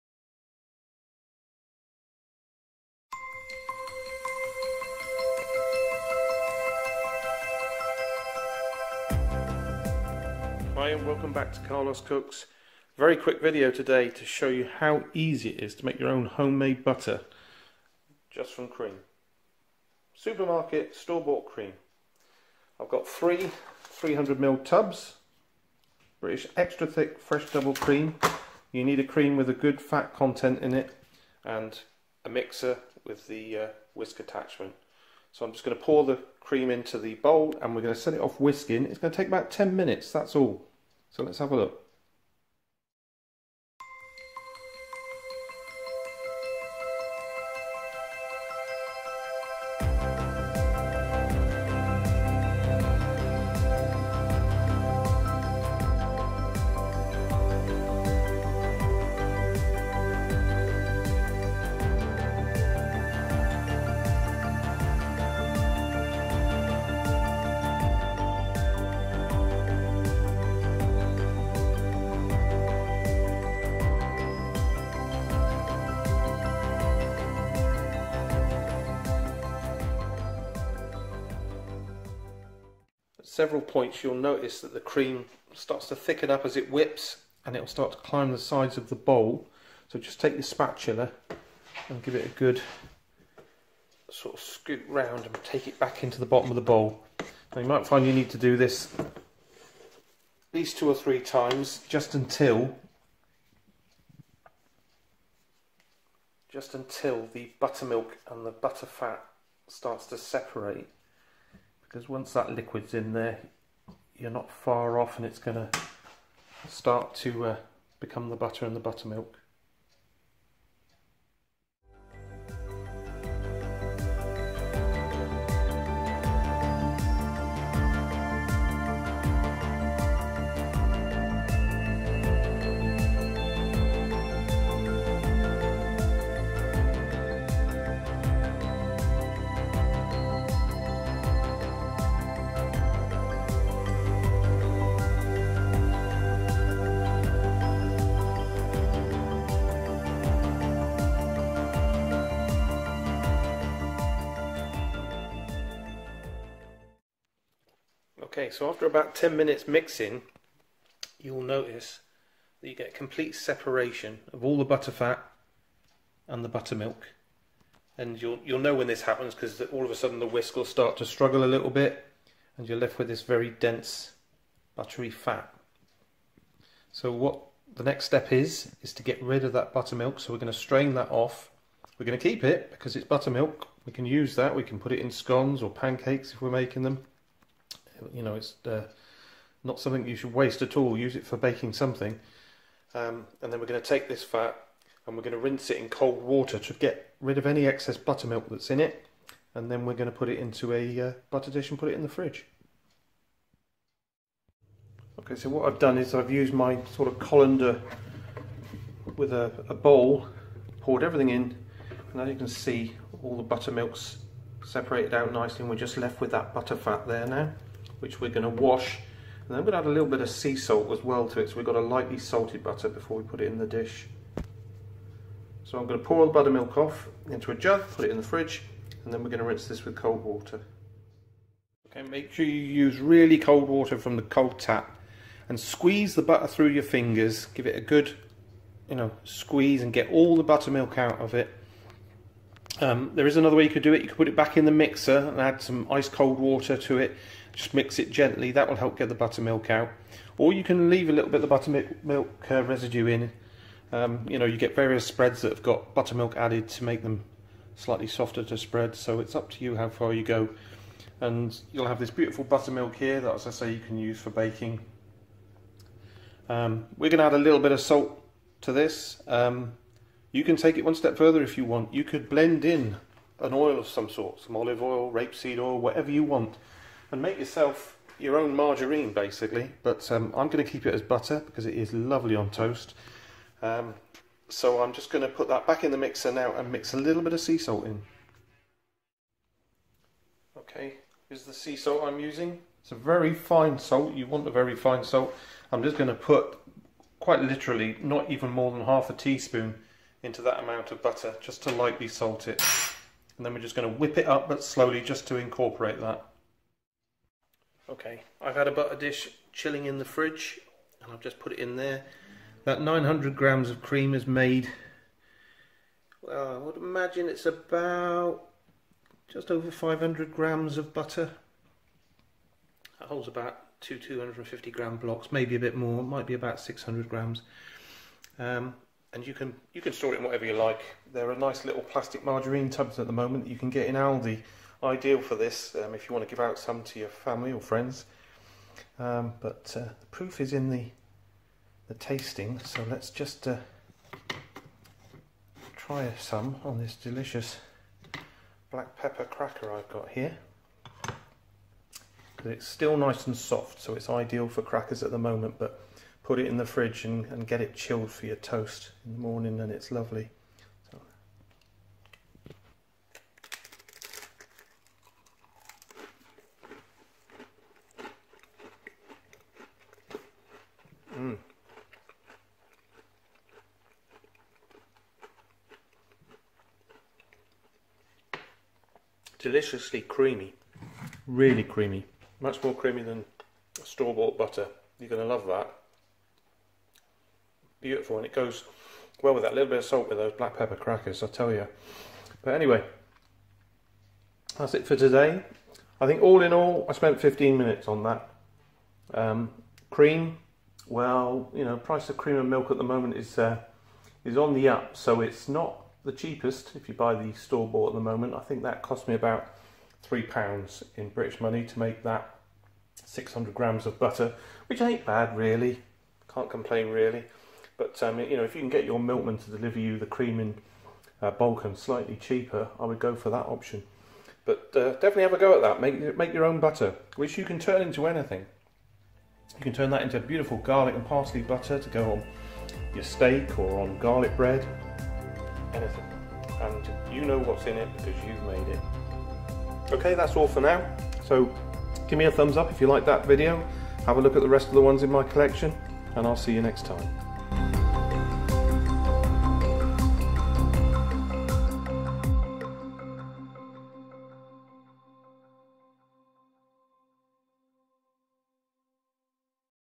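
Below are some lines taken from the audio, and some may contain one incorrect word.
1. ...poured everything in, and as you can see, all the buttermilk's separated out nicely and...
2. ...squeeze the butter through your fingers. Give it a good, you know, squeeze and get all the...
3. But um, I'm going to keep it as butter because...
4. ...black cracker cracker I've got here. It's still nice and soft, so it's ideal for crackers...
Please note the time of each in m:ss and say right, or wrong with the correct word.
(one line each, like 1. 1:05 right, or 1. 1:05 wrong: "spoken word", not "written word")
1. 3:30 right
2. 3:55 right
3. 4:39 right
4. 5:48 wrong: "pepper", not "cracker".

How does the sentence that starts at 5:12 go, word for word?
That 900 grams of cream is made, well, I would imagine it's about just over 500 grams of butter.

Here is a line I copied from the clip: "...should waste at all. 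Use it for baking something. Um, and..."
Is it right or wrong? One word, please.
right.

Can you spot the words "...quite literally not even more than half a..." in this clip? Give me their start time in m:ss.
4:57.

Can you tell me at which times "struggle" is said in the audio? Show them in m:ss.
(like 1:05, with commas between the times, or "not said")
2:51.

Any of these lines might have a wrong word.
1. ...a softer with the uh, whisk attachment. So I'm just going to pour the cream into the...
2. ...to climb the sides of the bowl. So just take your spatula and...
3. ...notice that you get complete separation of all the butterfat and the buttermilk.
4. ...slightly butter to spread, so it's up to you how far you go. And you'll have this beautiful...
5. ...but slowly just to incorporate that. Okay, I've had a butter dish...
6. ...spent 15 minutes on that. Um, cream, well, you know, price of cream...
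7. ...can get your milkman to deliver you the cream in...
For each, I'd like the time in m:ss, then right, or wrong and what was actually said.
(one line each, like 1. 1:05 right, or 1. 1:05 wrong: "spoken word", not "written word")
1. 0:32 wrong: "mixer", not "softer"
2. 1:27 right
3. 2:41 right
4. 4:17 wrong: "softer", not "butter"
5. 5:04 right
6. 6:36 right
7. 6:58 right.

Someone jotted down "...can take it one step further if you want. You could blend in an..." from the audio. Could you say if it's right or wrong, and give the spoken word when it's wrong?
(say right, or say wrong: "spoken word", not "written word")
right.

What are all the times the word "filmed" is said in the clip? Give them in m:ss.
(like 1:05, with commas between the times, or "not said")
not said.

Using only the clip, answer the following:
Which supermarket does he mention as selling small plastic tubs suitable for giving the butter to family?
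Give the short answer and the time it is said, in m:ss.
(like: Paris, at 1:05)
Aldi, at 5:33.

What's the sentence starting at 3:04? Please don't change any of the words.
We can put it in scones or pancakes if we're making them.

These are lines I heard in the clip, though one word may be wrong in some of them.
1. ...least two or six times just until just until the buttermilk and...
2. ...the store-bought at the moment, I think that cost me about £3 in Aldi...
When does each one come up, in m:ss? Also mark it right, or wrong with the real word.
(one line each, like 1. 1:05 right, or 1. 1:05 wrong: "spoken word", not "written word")
1. 1:40 wrong: "three", not "six"
2. 6:47 wrong: "British", not "Aldi".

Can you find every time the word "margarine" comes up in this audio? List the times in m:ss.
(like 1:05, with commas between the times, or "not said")
4:38, 5:32.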